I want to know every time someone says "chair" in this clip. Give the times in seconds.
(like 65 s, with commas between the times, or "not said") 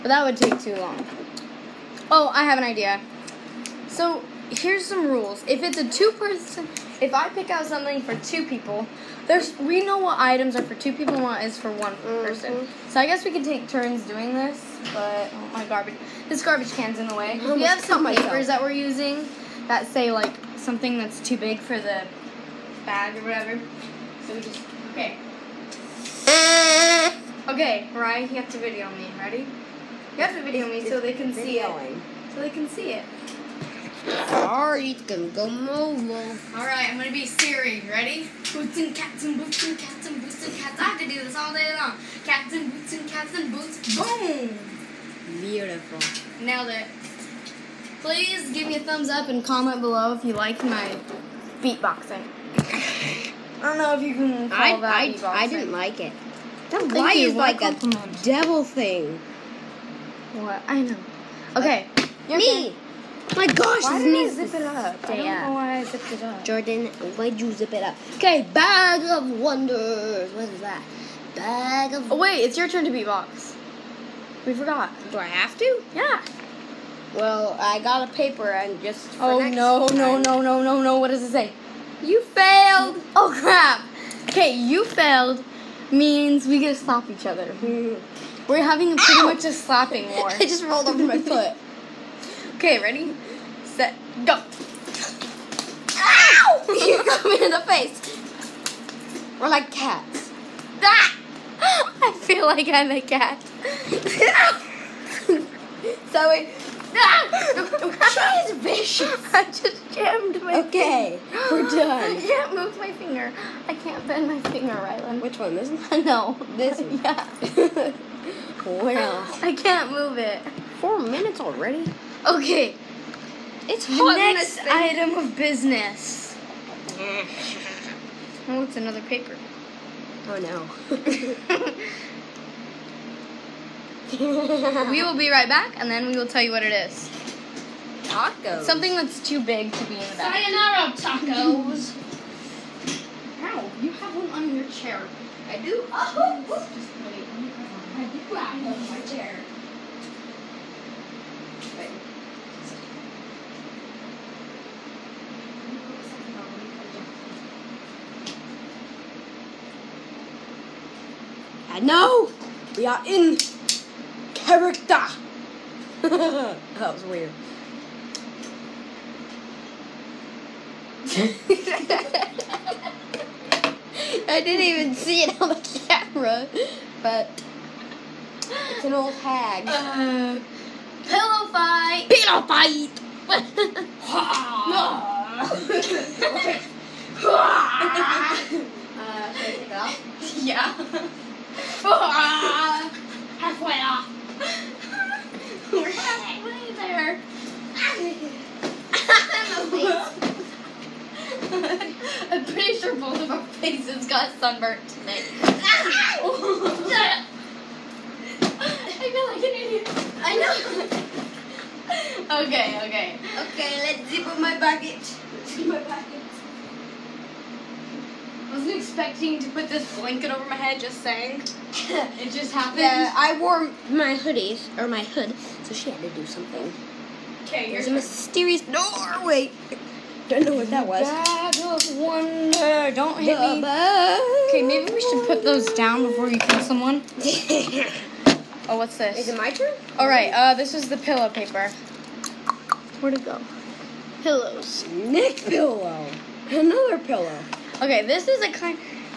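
144 s, 149 s.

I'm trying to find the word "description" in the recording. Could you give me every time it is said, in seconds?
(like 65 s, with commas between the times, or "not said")
not said.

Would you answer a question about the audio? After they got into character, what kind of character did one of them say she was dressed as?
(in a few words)
An old hag.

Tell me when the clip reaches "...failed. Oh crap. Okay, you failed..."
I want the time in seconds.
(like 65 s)
82 s.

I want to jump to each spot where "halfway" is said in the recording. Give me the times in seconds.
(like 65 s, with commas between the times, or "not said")
191 s, 195 s.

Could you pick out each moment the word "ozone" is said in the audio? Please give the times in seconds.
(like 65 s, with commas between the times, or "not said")
not said.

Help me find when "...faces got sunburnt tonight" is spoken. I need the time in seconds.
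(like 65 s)
203 s.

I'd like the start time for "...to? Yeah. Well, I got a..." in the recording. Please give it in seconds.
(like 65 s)
75 s.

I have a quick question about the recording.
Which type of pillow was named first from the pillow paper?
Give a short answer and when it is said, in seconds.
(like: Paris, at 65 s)
Neck pillow, at 244 s.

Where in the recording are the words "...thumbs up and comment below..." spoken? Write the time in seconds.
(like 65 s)
48 s.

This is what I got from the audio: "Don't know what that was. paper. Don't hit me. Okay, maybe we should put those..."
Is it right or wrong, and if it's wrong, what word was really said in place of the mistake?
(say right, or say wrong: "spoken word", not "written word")
wrong: "wonder", not "paper".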